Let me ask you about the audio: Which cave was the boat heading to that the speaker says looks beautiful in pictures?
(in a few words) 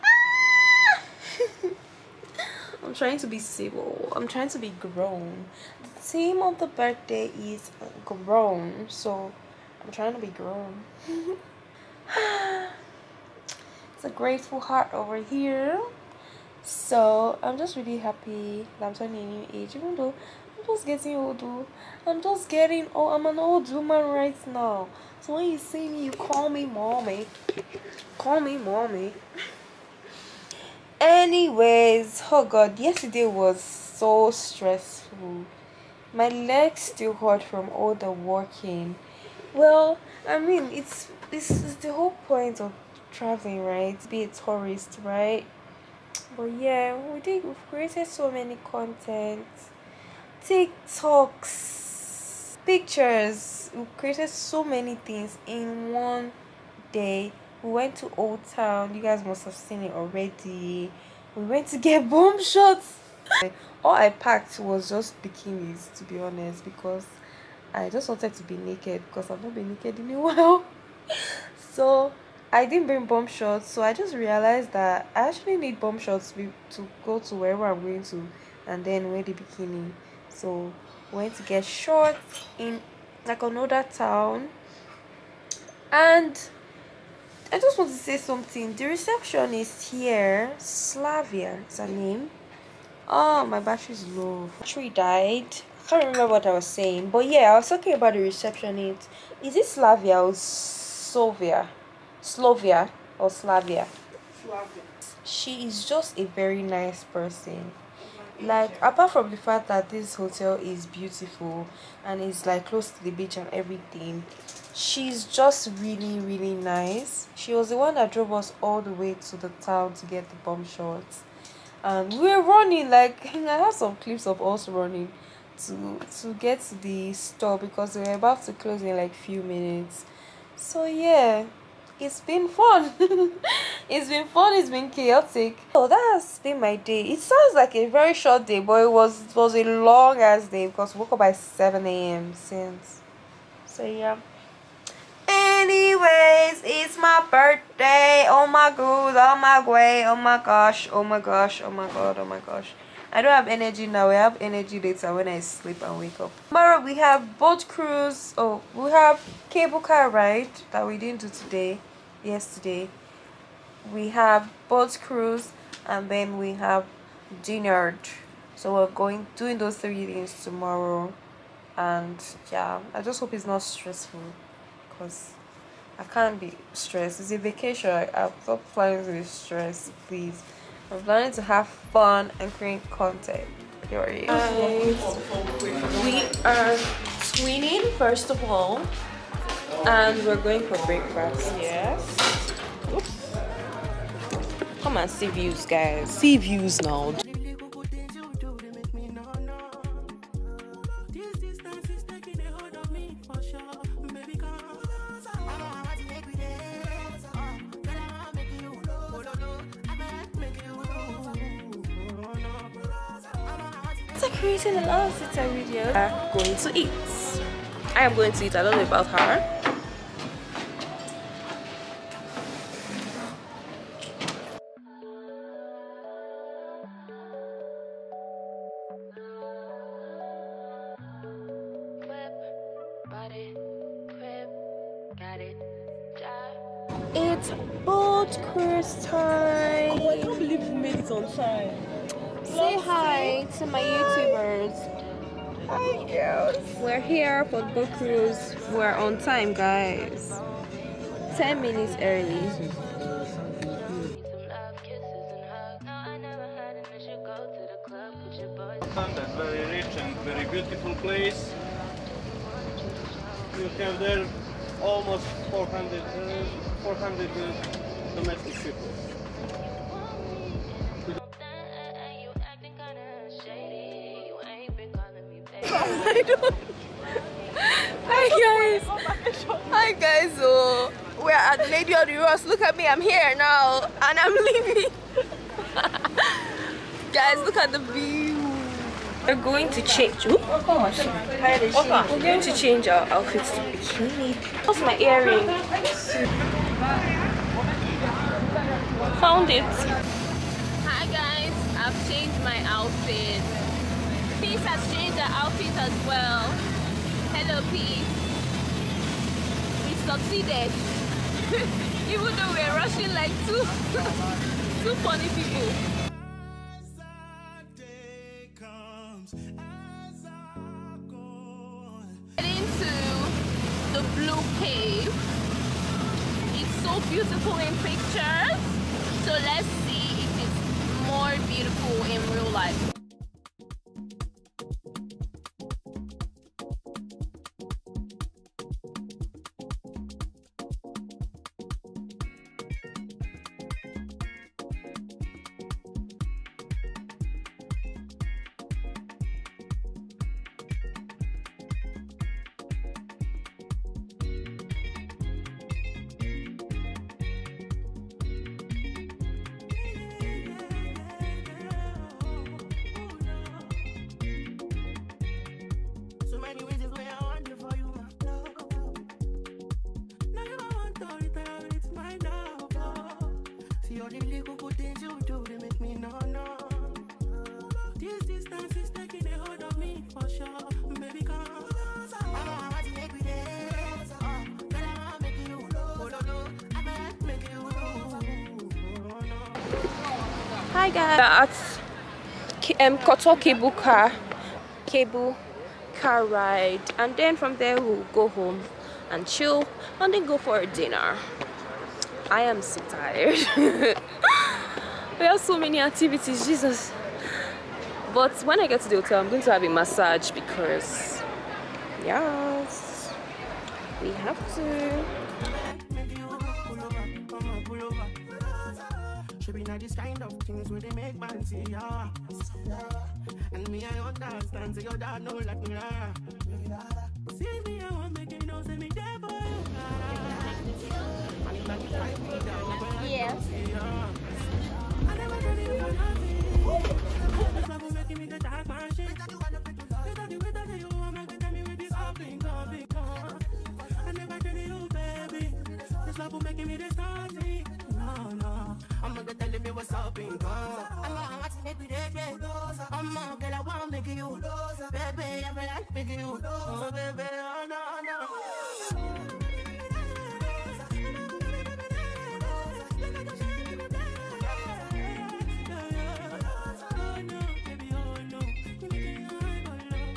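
Blue Cave.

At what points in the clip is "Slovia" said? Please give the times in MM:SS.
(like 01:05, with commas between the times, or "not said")
01:42.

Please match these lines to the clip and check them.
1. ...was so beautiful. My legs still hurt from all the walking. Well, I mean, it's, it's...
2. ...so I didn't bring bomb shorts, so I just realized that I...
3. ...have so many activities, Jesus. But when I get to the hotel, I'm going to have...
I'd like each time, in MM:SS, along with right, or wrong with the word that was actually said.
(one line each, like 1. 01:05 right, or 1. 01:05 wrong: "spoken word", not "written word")
1. 00:33 wrong: "stressful", not "beautiful"
2. 01:11 right
3. 06:45 right.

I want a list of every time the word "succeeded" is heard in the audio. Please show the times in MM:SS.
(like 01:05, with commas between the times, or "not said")
05:10.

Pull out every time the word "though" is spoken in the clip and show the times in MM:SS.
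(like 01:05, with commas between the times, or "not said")
00:19, 05:12.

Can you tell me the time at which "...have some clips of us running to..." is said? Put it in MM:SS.
02:03.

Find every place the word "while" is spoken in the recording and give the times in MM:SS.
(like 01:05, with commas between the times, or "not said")
01:10.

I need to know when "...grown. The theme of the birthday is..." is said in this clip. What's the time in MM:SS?
00:04.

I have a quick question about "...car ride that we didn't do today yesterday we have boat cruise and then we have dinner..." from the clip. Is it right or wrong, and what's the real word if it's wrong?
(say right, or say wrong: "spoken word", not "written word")
right.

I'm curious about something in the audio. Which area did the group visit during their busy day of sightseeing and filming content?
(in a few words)
Old Town.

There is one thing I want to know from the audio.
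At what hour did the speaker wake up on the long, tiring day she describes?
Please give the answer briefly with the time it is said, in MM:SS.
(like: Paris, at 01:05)
7 a.m., at 02:21.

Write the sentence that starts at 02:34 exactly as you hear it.
I have energy later when I sleep and wake up.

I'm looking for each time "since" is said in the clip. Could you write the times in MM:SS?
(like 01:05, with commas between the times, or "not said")
02:22.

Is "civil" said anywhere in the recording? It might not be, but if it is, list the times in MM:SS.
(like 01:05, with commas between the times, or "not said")
00:03.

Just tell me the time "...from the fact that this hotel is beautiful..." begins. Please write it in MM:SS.
01:49.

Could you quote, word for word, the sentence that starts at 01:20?
So went to get shorts in like another town.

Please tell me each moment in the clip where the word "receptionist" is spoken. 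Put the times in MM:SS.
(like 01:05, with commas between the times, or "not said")
01:28, 01:38.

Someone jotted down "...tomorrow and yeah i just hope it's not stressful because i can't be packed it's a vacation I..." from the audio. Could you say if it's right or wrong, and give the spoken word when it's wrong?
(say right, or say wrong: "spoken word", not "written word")
wrong: "stressed", not "packed".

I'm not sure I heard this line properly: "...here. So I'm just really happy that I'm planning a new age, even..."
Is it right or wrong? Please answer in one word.
wrong.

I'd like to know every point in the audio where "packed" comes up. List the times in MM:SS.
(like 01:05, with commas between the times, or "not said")
01:04.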